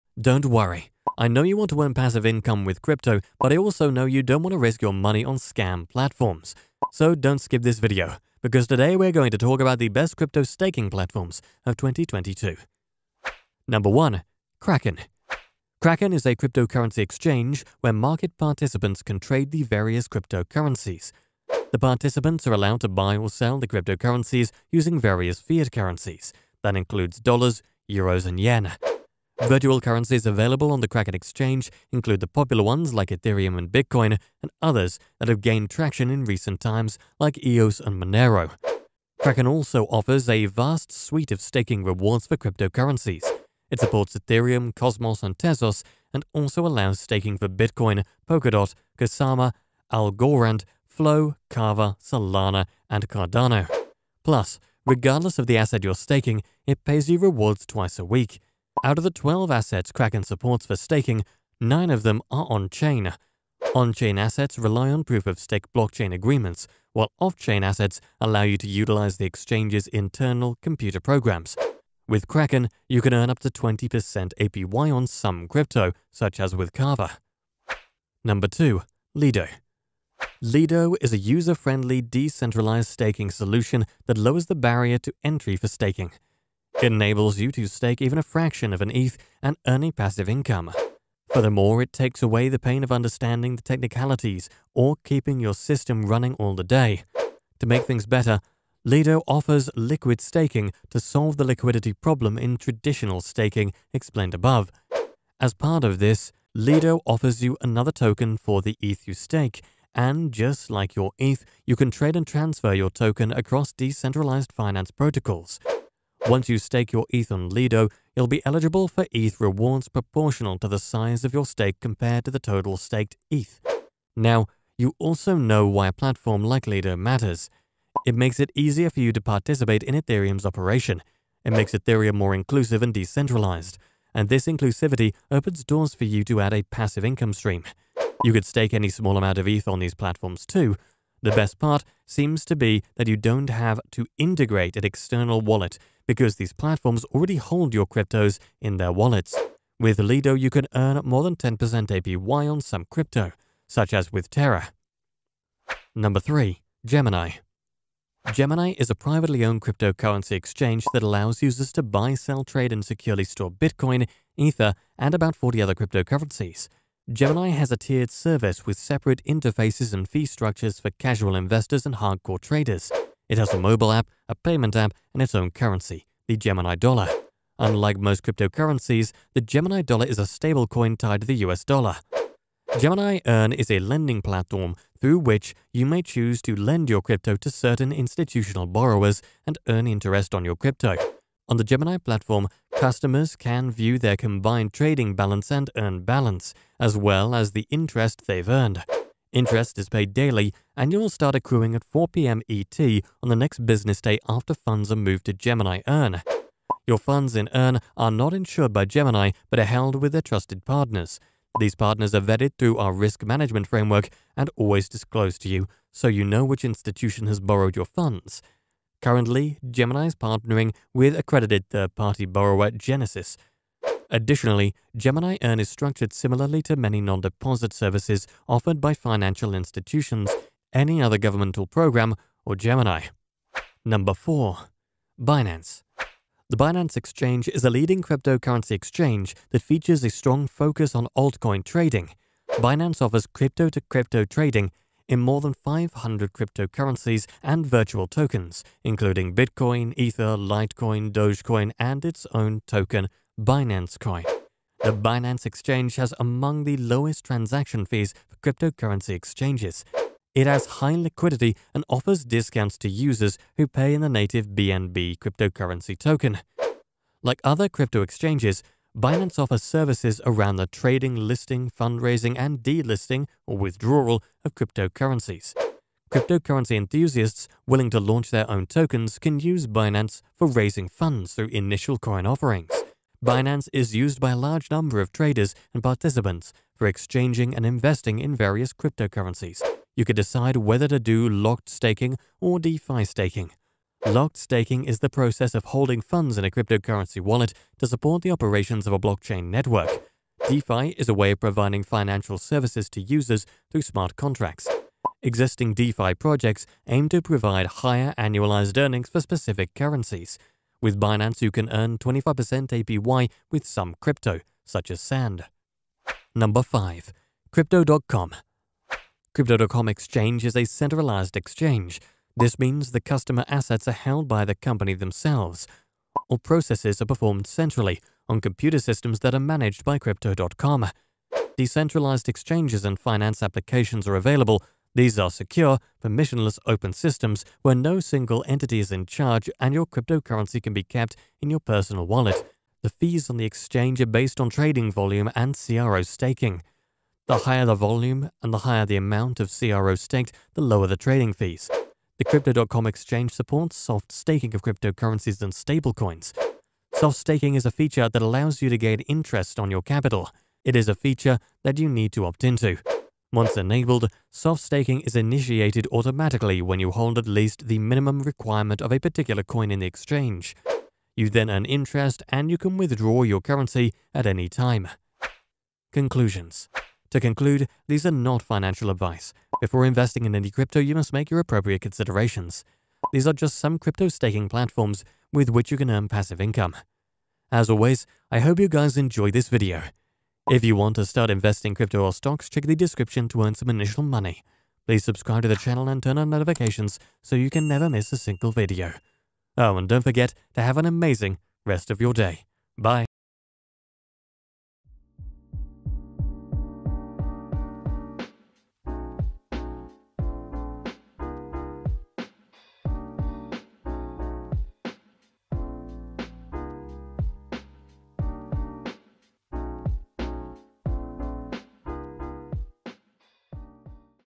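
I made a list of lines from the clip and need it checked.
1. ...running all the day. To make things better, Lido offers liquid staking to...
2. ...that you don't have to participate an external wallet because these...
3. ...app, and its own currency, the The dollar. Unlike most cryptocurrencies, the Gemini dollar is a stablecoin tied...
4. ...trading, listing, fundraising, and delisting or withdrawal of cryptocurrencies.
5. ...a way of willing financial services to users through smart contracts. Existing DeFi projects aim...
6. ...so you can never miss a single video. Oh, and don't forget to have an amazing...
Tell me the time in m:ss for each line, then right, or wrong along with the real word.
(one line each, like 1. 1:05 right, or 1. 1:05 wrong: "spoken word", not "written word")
1. 1:36 right
2. 2:22 wrong: "integrate", not "participate"
3. 2:54 wrong: "Gemini", not "The"
4. 4:30 right
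5. 5:01 wrong: "providing", not "willing"
6. 6:37 right.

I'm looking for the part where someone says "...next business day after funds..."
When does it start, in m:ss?
3:23.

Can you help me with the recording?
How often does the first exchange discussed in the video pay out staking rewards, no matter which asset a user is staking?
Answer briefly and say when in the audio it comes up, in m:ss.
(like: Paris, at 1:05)
Twice a week, at 0:57.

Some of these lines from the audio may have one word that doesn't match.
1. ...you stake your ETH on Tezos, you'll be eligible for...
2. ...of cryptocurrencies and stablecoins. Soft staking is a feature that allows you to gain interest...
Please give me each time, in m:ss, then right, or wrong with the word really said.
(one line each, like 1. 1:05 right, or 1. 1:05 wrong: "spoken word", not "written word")
1. 1:56 wrong: "Lido", not "Tezos"
2. 5:54 right.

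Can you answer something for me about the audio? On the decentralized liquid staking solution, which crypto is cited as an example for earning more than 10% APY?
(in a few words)
Terra.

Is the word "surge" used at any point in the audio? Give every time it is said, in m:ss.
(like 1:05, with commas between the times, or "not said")
not said.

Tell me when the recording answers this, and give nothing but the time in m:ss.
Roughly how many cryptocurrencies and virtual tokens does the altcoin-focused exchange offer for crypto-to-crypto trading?
4:05.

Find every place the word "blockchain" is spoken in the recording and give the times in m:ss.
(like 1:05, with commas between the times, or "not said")
1:05, 4:58.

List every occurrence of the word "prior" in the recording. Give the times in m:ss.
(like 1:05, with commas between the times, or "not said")
not said.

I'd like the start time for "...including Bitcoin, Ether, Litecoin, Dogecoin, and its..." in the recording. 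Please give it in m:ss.
4:08.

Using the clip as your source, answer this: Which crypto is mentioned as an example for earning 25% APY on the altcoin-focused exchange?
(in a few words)
Sand.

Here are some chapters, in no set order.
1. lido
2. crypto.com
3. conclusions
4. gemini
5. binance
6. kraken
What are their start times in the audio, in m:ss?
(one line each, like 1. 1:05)
1. 1:17
2. 5:16
3. 6:15
4. 2:35
5. 3:53
6. 0:13.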